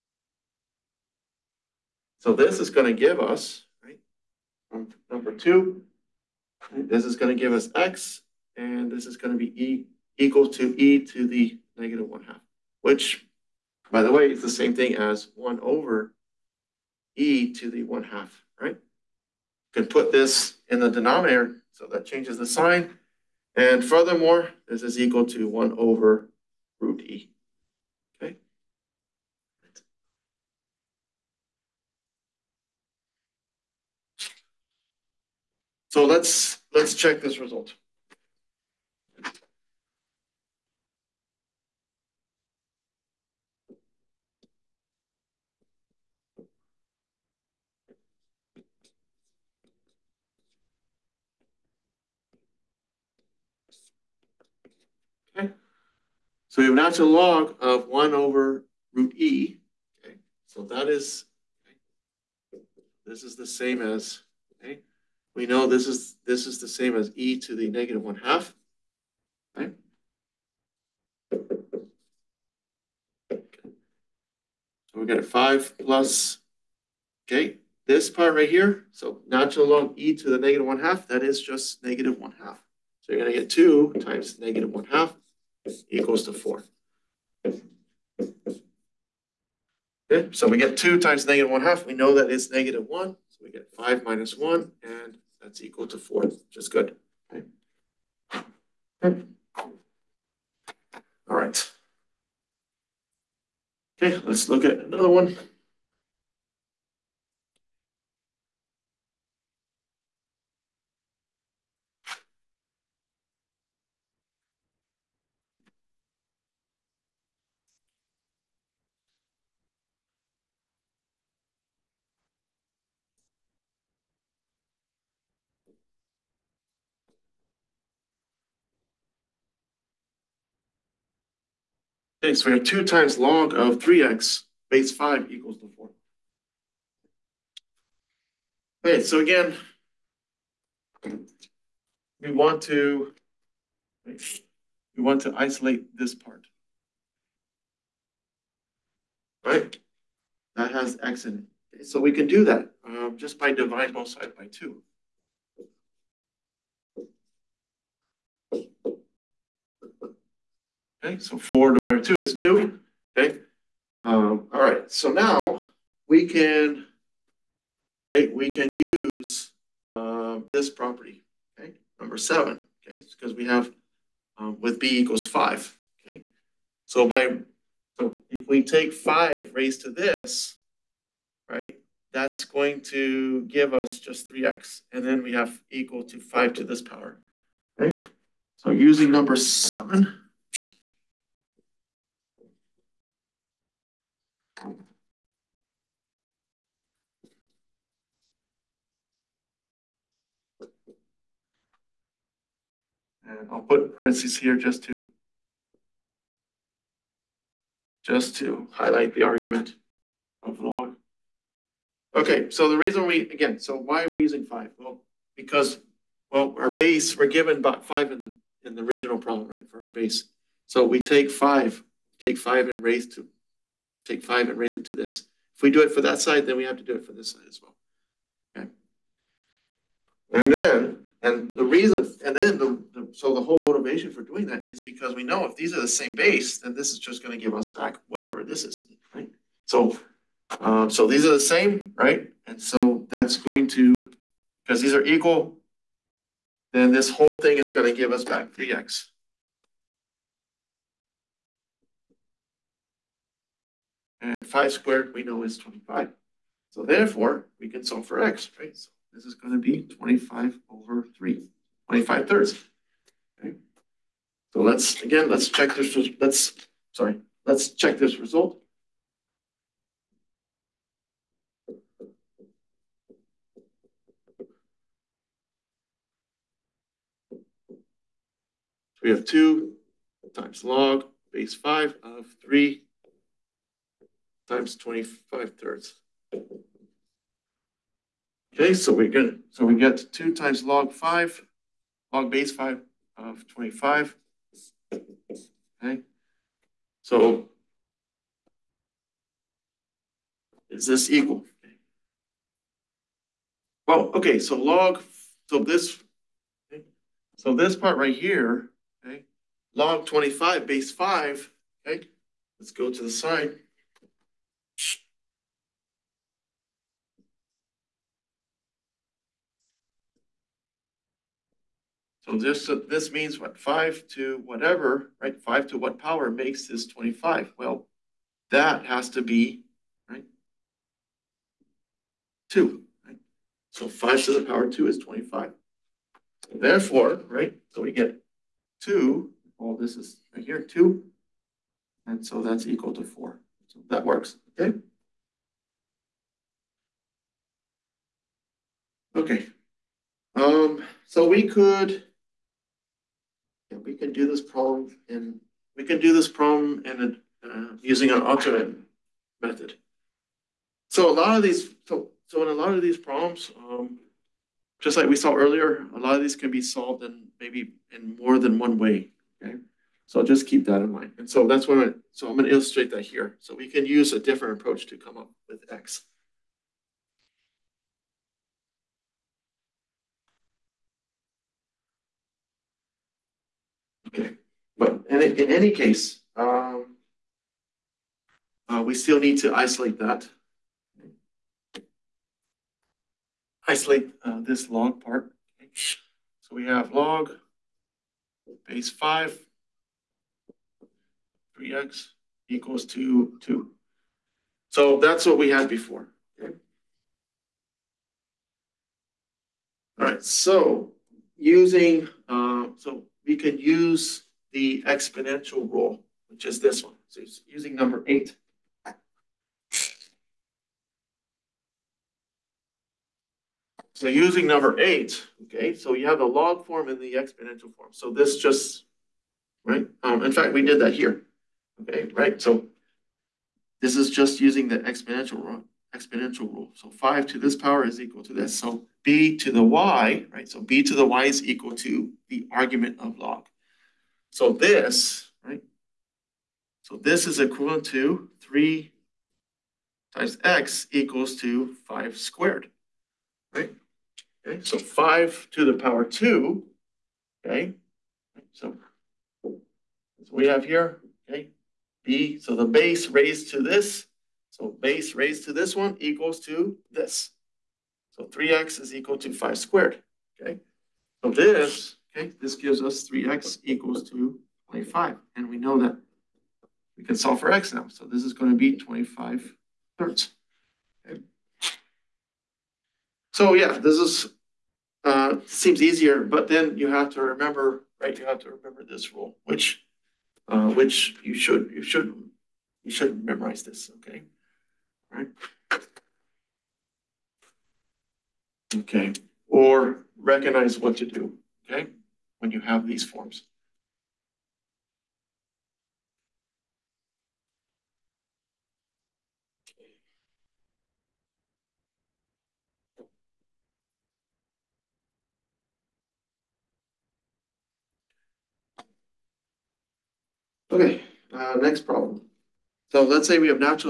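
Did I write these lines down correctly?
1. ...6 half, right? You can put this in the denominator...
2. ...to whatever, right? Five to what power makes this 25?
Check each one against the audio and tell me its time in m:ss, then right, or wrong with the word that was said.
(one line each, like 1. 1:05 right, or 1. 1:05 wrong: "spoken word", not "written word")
1. 0:17 wrong: "1", not "6"
2. 5:24 right.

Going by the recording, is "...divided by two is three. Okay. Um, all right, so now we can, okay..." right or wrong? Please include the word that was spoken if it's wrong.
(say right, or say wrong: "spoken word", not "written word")
wrong: "two", not "three".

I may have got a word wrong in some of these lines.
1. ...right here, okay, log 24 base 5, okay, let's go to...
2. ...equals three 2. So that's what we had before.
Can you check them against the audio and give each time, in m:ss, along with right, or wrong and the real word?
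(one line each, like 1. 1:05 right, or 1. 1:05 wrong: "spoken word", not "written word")
1. 5:07 wrong: "25", not "24"
2. 6:42 wrong: "two", not "three".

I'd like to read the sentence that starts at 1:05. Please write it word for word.
we know this is, this is the same as e to the negative 1 half.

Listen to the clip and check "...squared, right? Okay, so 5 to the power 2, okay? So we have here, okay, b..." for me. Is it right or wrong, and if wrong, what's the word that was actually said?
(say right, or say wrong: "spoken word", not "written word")
right.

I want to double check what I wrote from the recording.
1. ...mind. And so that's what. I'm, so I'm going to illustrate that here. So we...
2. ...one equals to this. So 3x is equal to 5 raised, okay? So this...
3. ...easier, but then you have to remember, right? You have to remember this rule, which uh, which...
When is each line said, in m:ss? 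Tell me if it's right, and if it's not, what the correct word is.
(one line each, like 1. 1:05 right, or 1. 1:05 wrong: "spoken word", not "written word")
1. 6:10 right
2. 7:45 wrong: "squared", not "raised"
3. 8:05 right.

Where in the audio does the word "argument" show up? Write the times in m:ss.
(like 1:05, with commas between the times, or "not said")
3:29, 7:22.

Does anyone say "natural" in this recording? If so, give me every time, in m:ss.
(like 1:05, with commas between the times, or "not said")
0:56, 1:19.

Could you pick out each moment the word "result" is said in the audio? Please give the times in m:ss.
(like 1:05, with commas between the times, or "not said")
0:37, 4:28.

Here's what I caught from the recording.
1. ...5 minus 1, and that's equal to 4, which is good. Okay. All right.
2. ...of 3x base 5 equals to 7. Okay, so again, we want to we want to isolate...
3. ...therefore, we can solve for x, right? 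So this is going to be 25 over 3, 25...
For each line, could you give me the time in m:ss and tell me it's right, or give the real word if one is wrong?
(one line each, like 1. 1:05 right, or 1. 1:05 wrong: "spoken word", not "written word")
1. 1:33 right
2. 2:13 wrong: "4", not "7"
3. 4:16 right.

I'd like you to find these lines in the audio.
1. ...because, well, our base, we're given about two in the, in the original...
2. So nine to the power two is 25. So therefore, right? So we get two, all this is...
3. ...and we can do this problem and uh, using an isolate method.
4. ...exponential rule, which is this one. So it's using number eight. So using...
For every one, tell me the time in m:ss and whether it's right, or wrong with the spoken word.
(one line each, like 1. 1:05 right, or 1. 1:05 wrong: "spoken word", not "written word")
1. 3:35 wrong: "five", not "two"
2. 5:33 wrong: "five", not "nine"
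3. 5:55 wrong: "alternate", not "isolate"
4. 6:54 right.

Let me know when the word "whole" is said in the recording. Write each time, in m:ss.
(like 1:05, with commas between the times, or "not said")
3:53, 4:07.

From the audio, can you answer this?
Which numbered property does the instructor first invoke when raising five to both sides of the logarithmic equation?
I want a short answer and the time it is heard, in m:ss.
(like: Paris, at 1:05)
7, at 2:52.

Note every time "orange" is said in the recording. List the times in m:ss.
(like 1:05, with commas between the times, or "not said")
not said.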